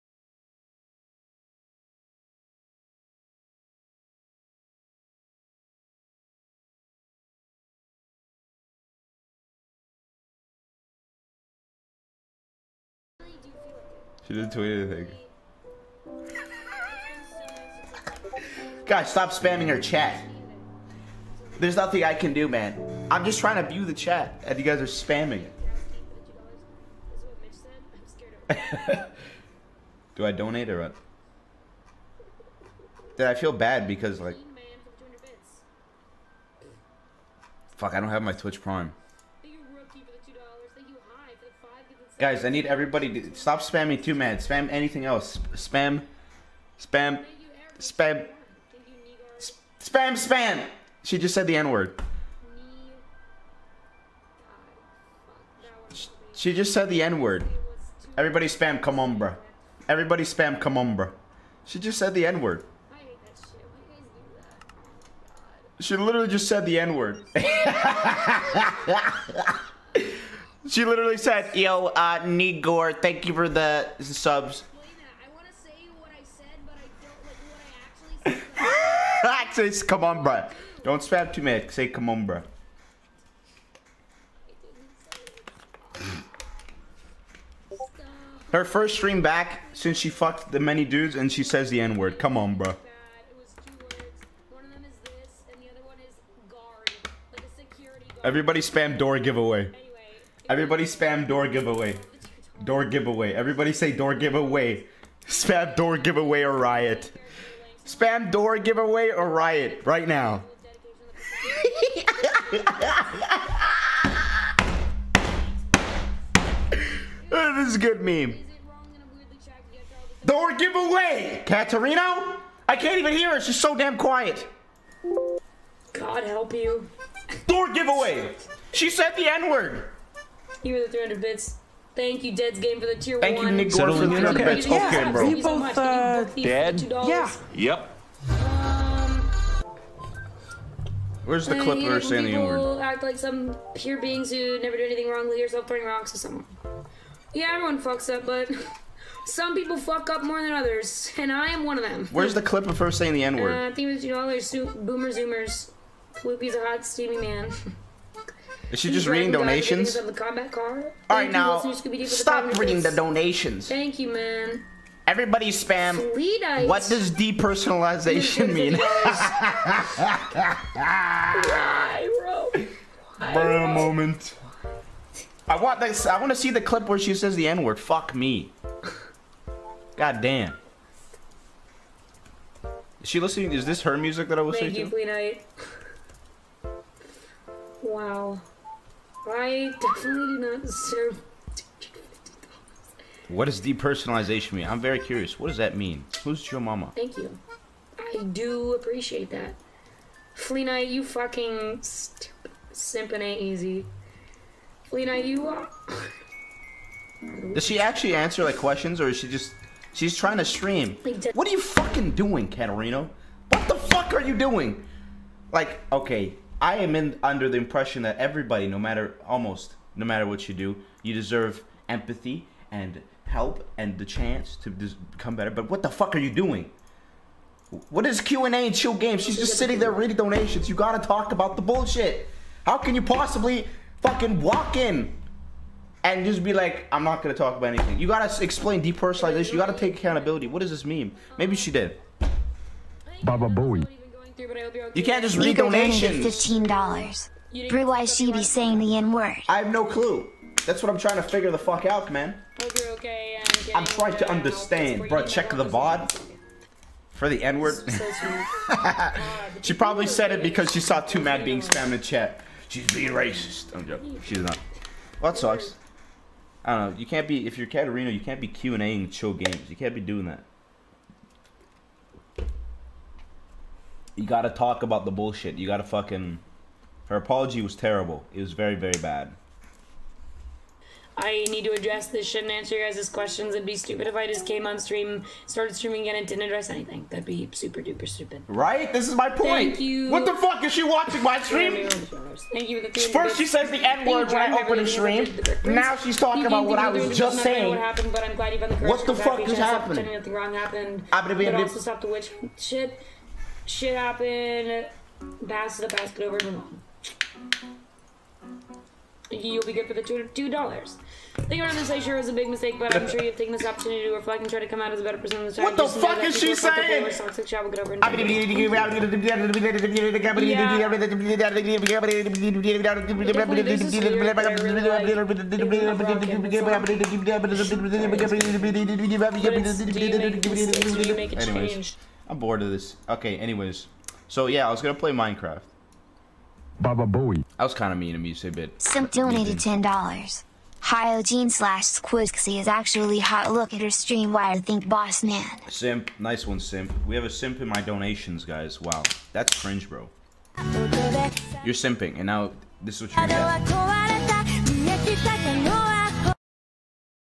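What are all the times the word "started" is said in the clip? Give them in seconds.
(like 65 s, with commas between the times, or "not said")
285 s.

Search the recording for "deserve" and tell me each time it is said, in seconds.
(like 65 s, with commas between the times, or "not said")
190 s, 221 s.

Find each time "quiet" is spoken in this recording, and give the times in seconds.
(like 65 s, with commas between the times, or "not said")
123 s.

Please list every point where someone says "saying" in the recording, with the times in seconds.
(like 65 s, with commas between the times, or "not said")
142 s, 152 s, 248 s, 297 s, 316 s.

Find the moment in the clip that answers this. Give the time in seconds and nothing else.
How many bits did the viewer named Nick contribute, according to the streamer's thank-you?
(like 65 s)
133 s.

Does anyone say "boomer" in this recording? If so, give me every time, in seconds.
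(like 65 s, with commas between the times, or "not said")
153 s.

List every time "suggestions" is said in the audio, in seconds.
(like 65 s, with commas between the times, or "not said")
not said.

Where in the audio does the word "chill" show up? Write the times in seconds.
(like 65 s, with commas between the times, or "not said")
228 s, 269 s.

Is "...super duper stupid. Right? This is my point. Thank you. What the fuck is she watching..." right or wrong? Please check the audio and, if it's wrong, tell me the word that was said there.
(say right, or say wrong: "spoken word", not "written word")
right.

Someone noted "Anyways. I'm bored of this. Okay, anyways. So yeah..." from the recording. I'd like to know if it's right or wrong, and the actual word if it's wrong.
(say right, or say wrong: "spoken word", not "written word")
right.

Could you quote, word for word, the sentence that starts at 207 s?
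does she actually answer like questions or is she just.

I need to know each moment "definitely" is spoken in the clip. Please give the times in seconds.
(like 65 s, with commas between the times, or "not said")
189 s.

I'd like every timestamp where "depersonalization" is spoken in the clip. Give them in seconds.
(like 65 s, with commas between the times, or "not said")
167 s, 193 s, 238 s.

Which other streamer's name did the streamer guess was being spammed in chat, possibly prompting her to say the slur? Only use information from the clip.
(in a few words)
twomad.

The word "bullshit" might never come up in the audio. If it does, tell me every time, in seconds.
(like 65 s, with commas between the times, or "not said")
231 s, 275 s.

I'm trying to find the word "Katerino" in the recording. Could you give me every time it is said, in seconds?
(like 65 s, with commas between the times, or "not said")
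121 s, 212 s, 267 s.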